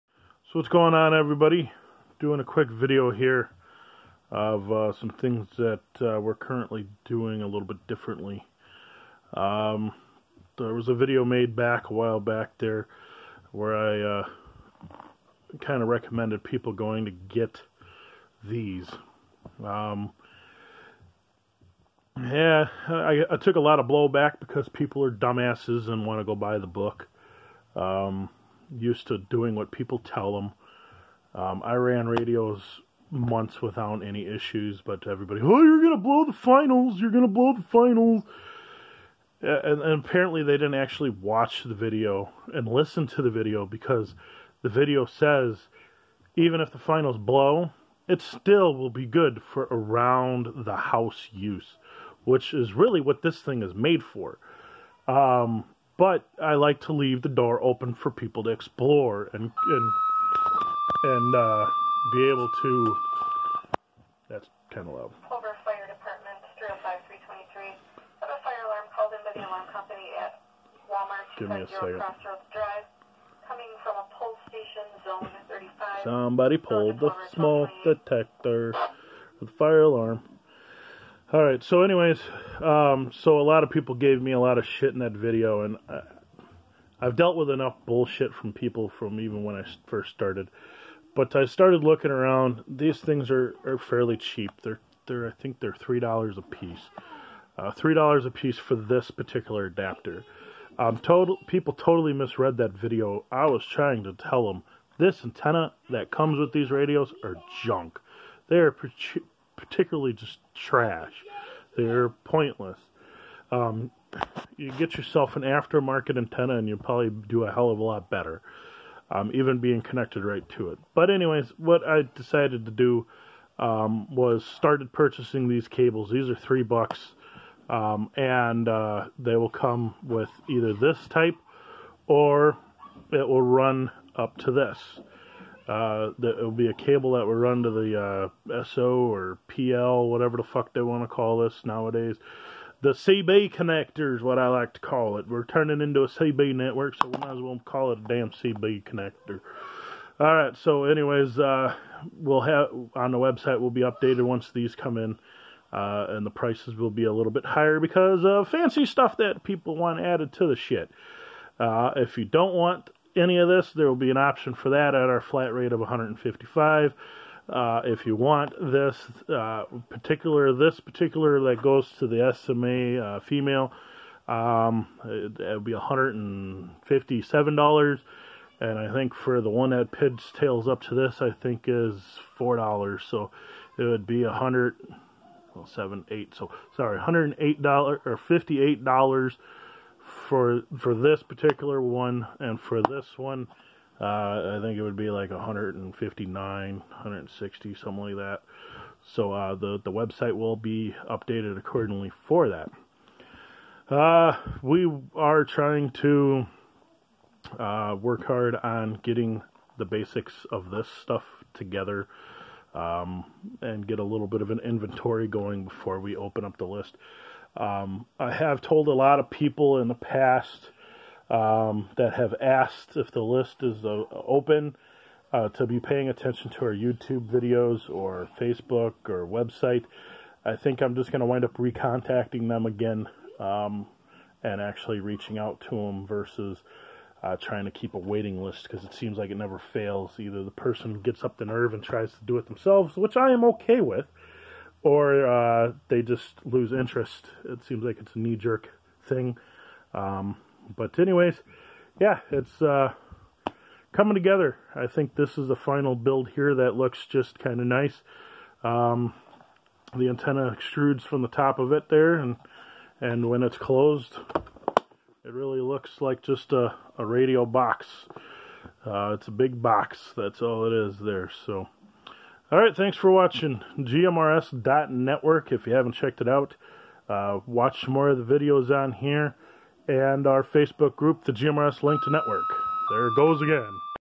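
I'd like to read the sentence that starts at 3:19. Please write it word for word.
So uh, the the website will be updated accordingly for that.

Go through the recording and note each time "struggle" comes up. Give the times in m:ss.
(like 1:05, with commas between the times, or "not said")
not said.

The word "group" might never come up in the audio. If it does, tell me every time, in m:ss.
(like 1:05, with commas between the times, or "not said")
4:40.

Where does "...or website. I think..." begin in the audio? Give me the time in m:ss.
3:49.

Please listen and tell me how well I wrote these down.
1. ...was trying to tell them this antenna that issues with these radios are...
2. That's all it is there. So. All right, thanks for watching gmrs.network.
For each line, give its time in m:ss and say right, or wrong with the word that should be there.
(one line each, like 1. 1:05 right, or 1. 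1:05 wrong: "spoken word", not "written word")
1. 1:43 wrong: "comes", not "issues"
2. 4:30 right.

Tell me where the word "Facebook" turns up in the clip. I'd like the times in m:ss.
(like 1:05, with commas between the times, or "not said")
3:48, 4:40.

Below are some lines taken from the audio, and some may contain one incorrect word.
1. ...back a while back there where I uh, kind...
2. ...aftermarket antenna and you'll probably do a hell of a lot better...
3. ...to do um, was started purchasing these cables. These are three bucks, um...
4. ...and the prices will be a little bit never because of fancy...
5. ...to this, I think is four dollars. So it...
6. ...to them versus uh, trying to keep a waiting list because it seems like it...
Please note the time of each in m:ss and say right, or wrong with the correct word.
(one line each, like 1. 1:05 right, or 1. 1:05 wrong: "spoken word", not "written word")
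1. 0:11 right
2. 1:55 right
3. 2:02 right
4. 2:36 wrong: "higher", not "never"
5. 3:00 right
6. 3:55 right.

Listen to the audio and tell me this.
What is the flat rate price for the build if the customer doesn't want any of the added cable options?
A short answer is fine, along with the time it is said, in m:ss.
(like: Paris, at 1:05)
$155, at 2:45.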